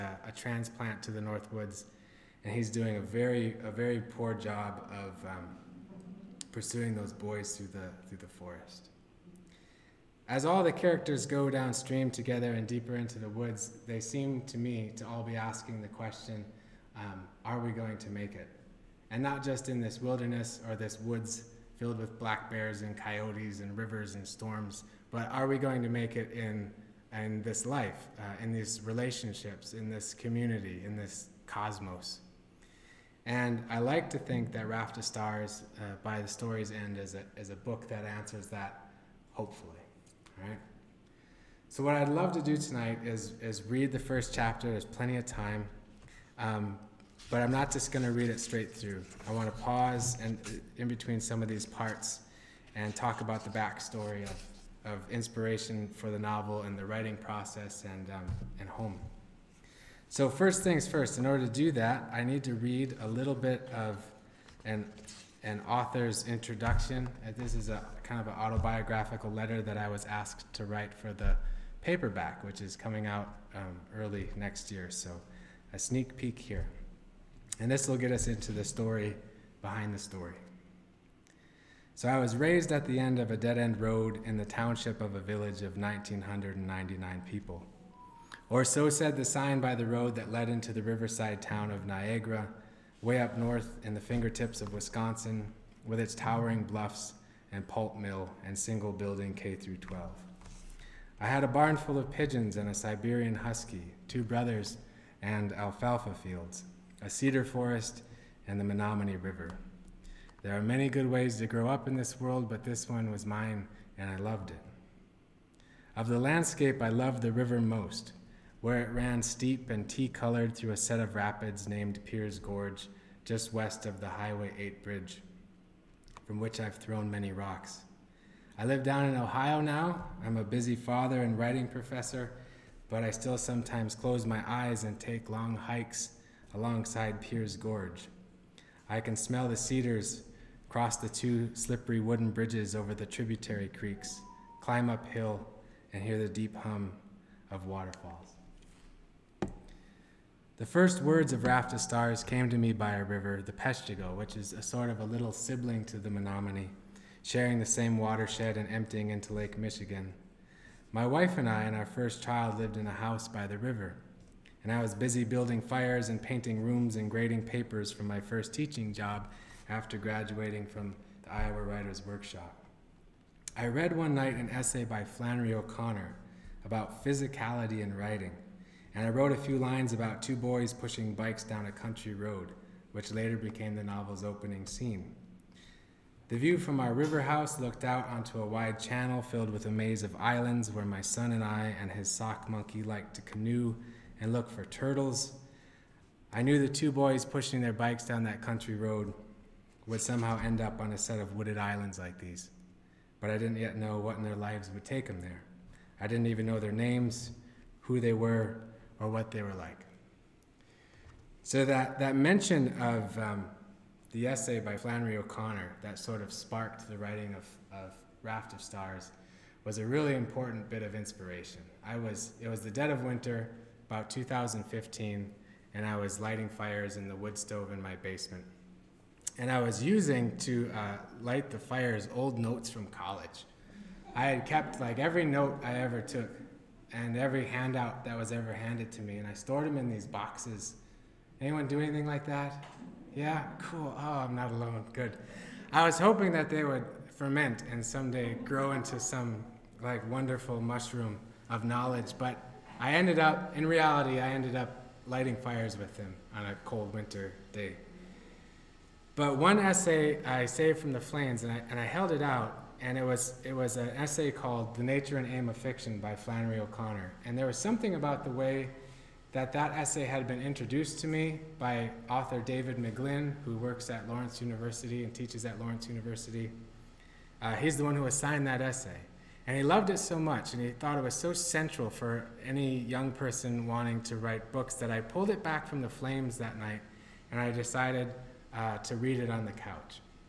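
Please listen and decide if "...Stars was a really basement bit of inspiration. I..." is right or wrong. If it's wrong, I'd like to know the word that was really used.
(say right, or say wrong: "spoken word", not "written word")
wrong: "important", not "basement".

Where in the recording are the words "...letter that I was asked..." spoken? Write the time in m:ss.
1:09.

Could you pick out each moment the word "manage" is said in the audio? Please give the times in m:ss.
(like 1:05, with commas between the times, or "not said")
not said.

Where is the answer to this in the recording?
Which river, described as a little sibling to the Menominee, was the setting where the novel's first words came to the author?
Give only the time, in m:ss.
2:33.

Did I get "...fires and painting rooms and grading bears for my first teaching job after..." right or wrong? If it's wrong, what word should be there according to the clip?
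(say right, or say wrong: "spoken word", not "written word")
wrong: "papers", not "bears".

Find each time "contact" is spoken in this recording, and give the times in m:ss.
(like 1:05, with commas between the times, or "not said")
not said.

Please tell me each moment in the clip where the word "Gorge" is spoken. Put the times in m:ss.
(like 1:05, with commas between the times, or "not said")
2:02, 2:17.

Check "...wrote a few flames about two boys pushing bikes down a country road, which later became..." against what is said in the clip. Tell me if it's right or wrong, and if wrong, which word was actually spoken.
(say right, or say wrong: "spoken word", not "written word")
wrong: "lines", not "flames".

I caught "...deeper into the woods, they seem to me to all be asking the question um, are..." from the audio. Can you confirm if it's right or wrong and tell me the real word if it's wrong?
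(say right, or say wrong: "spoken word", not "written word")
right.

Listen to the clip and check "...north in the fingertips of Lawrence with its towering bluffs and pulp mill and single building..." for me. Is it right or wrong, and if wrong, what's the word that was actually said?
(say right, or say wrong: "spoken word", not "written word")
wrong: "Wisconsin", not "Lawrence".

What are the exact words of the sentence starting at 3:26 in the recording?
I didn't even know their names, who they were, or what they were like.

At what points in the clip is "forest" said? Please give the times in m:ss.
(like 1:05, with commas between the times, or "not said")
0:08, 1:47.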